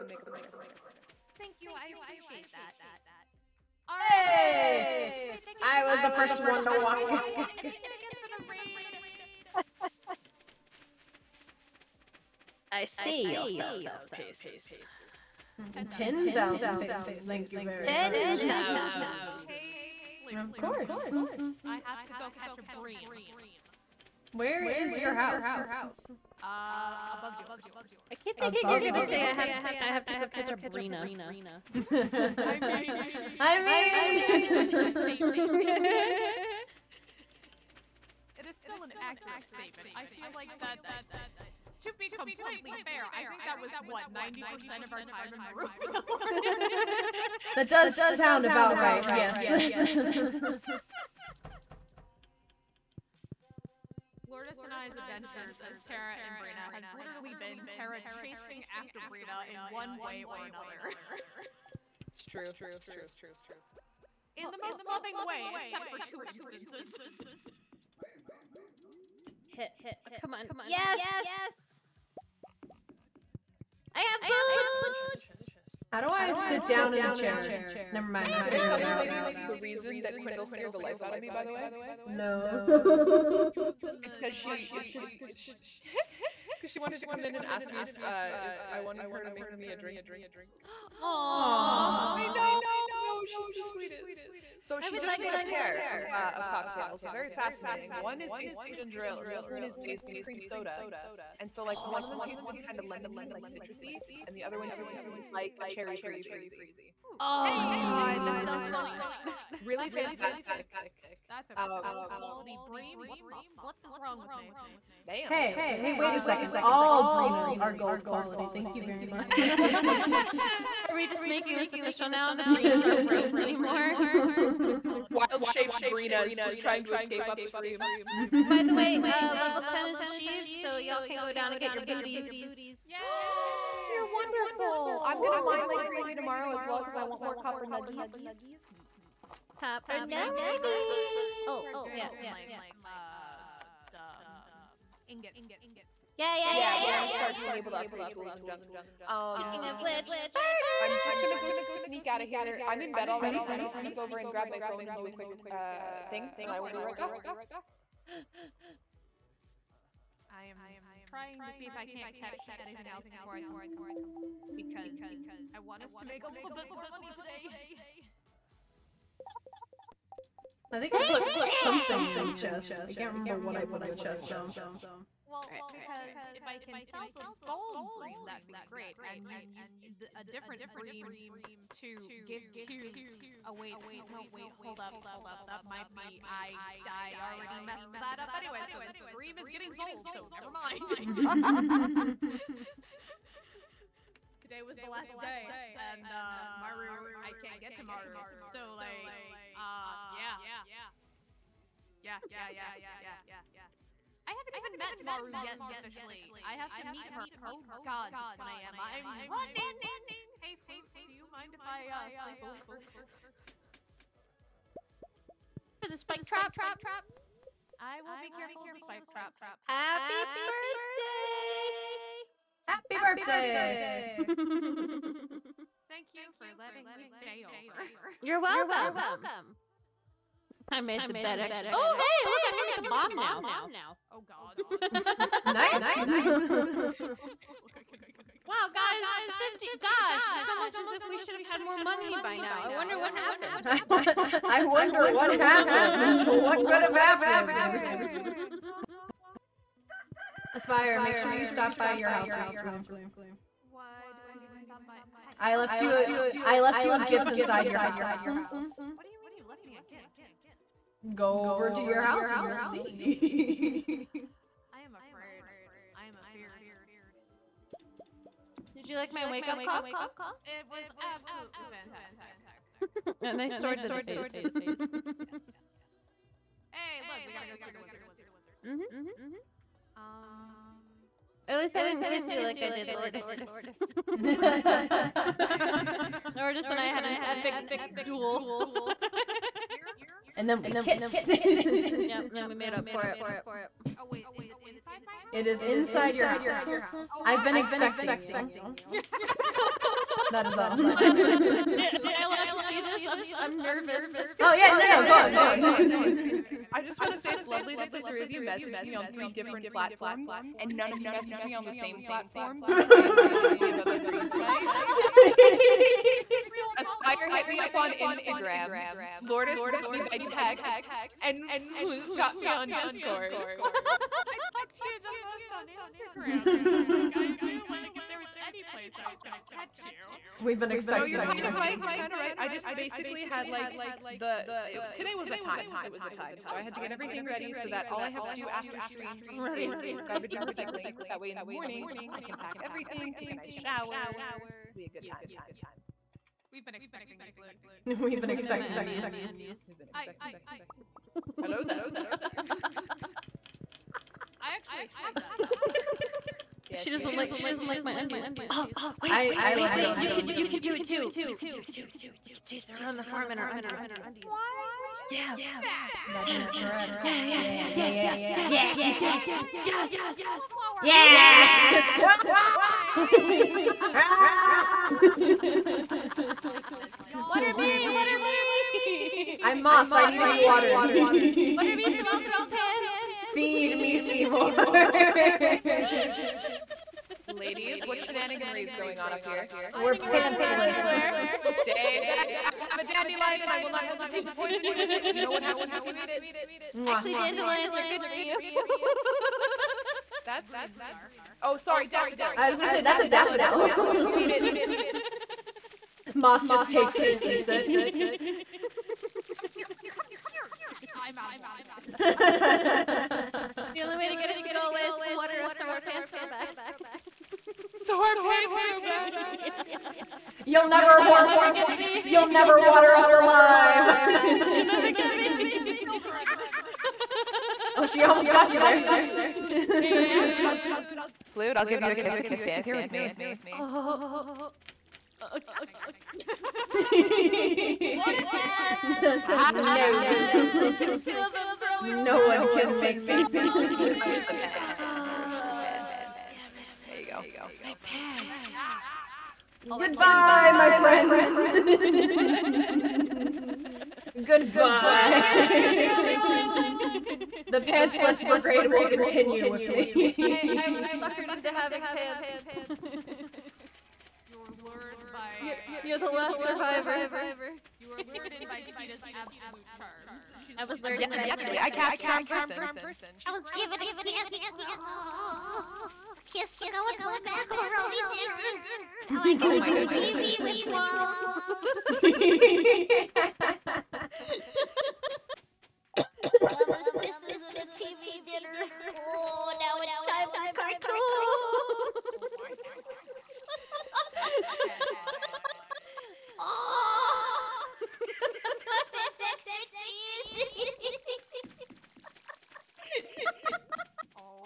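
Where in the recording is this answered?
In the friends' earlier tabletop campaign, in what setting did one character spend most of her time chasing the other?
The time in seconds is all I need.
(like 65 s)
45 s.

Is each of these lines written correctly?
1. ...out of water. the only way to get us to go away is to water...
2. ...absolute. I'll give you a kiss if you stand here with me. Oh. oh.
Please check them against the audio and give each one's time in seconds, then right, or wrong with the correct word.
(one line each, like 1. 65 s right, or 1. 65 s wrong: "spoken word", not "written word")
1. 411 s right
2. 431 s wrong: "flute", not "absolute".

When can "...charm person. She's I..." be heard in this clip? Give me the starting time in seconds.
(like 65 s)
471 s.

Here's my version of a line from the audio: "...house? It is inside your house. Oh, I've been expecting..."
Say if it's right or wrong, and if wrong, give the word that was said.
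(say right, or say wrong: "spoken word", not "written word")
right.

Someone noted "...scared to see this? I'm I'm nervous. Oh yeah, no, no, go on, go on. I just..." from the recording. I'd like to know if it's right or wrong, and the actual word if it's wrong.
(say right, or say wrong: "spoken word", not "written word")
wrong: "allowed", not "scared".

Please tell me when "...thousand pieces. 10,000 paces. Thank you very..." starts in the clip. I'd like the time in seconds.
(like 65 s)
13 s.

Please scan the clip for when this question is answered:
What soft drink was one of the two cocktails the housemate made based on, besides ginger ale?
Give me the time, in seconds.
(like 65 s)
100 s.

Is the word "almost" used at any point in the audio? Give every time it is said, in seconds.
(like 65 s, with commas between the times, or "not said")
240 s, 428 s.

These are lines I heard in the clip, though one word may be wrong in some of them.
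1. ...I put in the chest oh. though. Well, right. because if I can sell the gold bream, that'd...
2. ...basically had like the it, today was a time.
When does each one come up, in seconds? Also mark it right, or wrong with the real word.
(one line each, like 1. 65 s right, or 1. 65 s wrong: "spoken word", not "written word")
1. 173 s right
2. 332 s right.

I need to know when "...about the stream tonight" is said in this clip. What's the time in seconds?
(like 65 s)
313 s.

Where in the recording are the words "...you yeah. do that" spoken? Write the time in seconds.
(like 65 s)
364 s.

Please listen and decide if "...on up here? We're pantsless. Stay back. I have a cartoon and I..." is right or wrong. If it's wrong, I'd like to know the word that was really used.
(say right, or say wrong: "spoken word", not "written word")
wrong: "dandelion", not "cartoon".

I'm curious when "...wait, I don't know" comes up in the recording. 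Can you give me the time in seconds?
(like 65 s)
183 s.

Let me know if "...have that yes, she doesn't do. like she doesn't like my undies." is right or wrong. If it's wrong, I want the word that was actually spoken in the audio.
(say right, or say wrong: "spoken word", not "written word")
right.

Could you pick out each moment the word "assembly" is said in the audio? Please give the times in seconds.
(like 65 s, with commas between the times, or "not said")
not said.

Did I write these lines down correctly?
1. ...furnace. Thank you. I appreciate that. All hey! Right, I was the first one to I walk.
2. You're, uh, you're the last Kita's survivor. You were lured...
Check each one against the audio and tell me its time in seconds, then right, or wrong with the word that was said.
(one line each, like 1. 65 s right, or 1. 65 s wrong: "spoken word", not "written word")
1. 0 s right
2. 465 s right.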